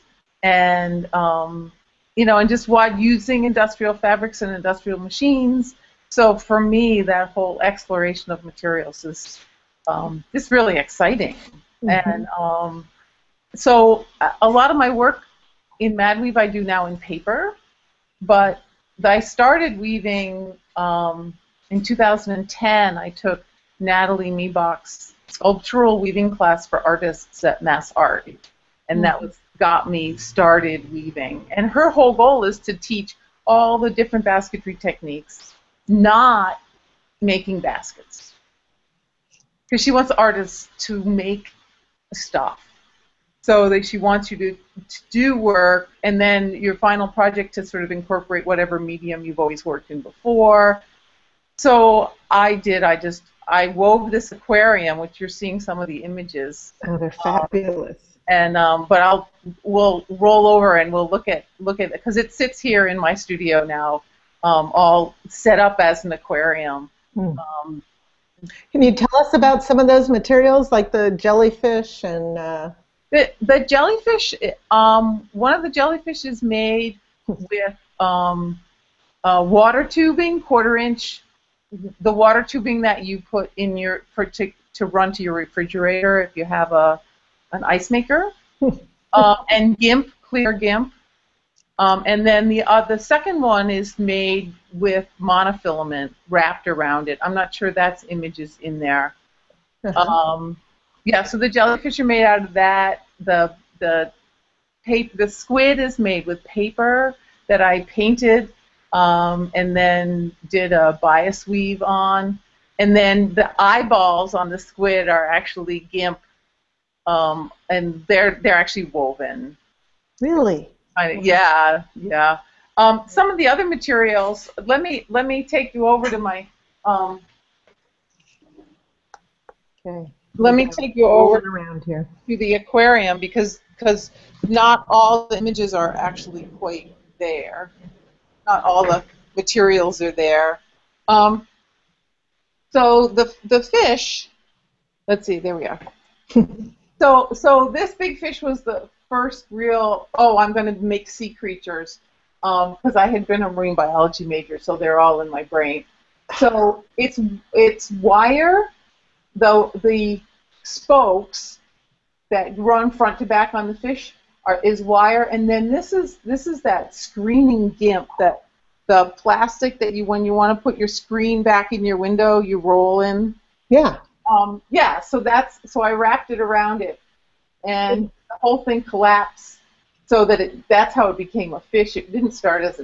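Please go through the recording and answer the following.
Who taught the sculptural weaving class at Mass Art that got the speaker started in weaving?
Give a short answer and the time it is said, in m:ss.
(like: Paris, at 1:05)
Nathalie Miebach, at 0:23.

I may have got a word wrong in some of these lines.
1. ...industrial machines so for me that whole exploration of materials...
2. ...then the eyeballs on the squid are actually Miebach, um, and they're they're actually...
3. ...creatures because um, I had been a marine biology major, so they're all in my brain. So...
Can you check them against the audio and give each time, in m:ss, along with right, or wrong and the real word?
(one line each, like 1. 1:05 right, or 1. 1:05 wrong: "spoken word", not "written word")
1. 0:04 right
2. 1:52 wrong: "GIMP", not "Miebach"
3. 2:31 right.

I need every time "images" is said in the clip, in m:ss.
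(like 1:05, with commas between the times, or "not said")
0:56, 1:38, 2:15.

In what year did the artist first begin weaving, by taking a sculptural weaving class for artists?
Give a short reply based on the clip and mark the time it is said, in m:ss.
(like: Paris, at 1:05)
2010, at 0:21.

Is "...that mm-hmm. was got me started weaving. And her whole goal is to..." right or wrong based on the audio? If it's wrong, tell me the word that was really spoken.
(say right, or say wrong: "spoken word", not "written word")
right.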